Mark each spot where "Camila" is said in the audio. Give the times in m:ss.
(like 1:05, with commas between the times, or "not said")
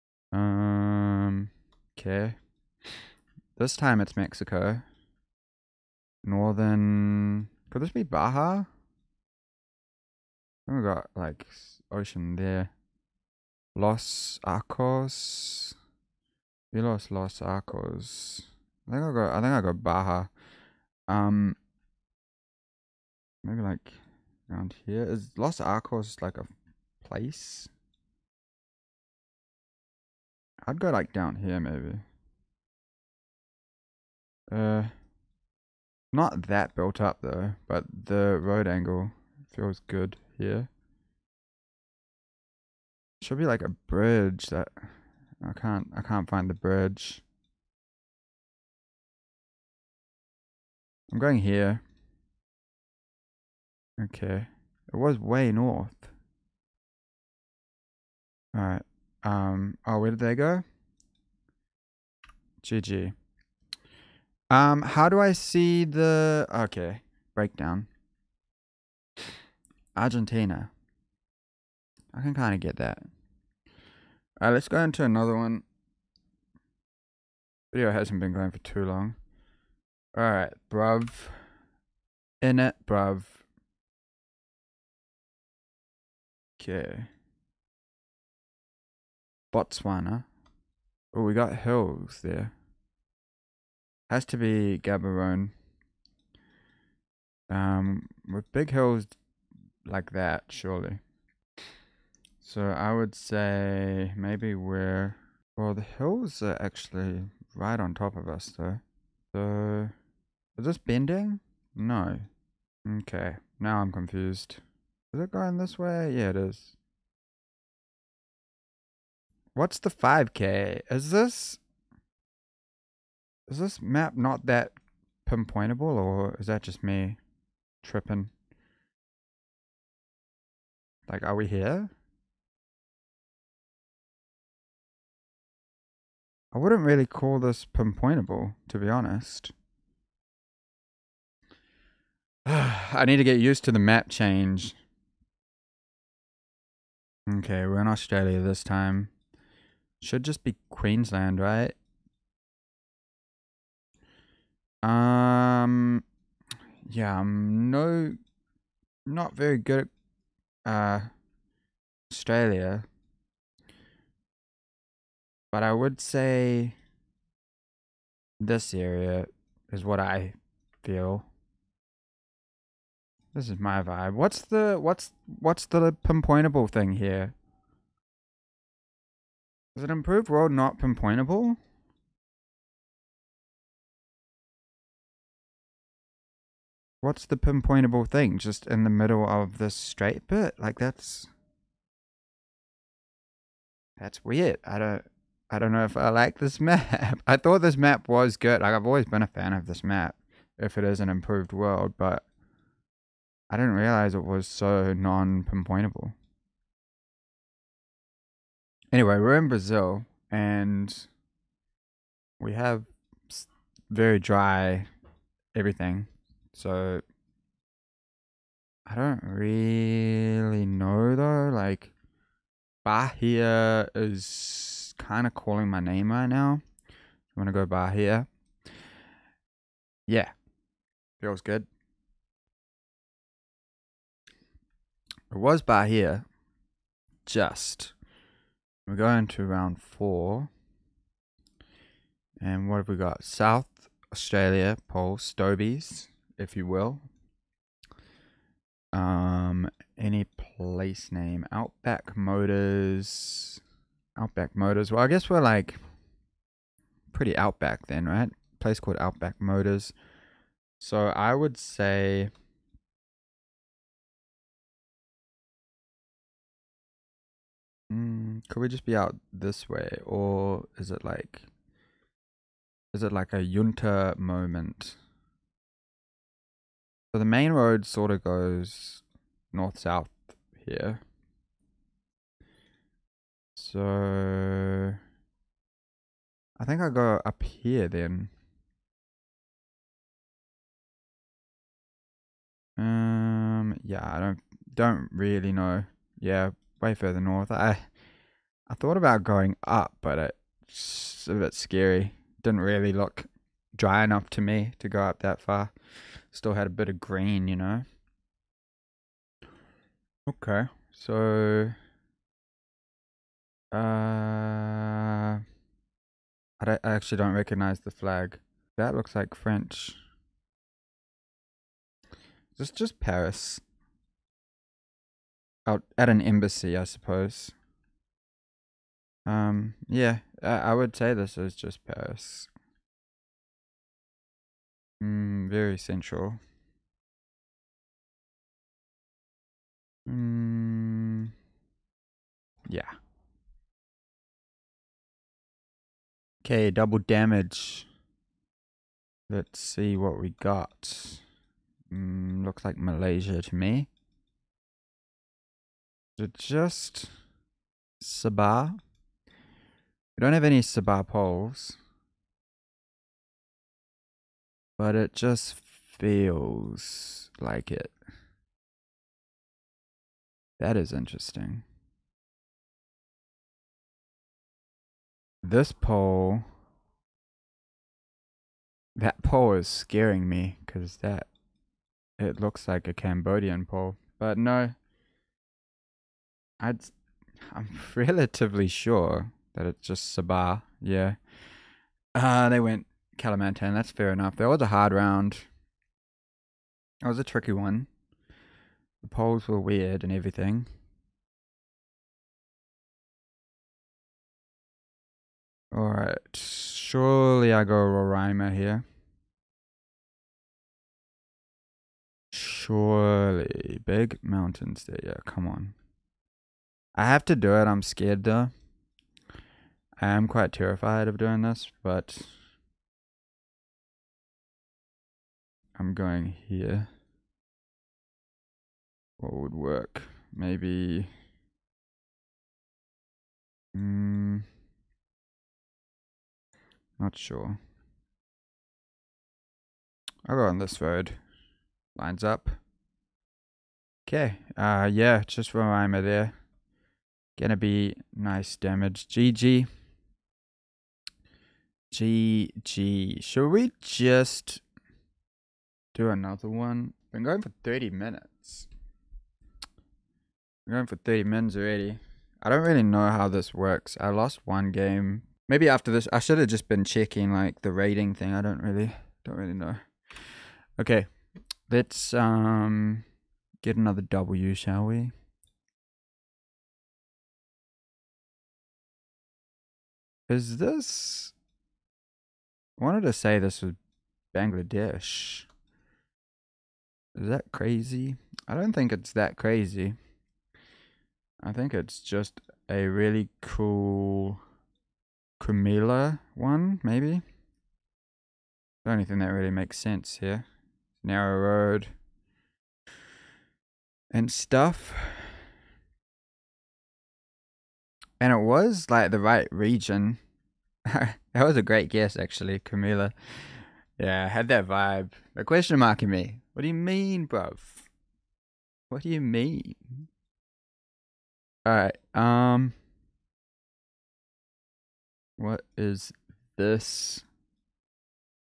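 8:15, 8:32.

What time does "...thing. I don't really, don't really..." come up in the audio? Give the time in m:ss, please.
7:48.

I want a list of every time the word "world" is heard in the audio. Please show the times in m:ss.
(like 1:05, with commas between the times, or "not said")
3:00, 3:21.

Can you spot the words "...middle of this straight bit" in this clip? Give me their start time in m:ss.
3:08.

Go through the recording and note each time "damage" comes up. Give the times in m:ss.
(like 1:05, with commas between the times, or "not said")
5:46, 7:28.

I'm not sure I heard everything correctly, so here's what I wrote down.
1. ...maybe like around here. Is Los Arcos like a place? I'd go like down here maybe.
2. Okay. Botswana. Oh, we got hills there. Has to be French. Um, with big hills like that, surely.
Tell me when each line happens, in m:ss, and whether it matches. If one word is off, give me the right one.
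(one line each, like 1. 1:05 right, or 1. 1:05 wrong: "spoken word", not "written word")
1. 0:23 right
2. 1:26 wrong: "Gaborone", not "French".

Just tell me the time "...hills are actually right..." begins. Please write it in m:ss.
1:45.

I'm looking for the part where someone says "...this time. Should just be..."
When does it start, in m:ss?
2:28.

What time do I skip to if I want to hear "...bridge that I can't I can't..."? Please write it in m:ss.
0:43.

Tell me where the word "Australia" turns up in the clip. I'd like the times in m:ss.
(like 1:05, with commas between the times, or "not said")
2:27, 2:42, 4:04.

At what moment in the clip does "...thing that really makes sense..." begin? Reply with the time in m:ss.
8:19.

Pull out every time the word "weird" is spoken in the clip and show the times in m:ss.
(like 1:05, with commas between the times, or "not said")
3:14, 6:39.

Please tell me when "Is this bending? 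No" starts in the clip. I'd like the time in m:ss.
1:50.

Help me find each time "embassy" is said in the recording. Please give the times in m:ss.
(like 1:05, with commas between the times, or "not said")
5:26.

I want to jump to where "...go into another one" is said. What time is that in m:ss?
1:14.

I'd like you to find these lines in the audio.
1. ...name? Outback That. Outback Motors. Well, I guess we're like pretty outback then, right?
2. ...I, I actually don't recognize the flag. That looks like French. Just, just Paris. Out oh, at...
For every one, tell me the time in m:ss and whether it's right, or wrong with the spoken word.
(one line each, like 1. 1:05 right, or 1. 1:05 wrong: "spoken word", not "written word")
1. 4:11 wrong: "Motors", not "That"
2. 5:16 right.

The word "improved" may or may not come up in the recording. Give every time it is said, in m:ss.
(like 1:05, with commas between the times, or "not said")
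2:59, 3:21.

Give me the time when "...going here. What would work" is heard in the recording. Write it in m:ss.
7:05.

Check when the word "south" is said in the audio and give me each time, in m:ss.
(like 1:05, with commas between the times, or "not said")
4:03, 4:39.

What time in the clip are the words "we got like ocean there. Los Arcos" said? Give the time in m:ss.
0:10.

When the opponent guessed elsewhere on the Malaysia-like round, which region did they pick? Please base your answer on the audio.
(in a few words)
Kalimantan.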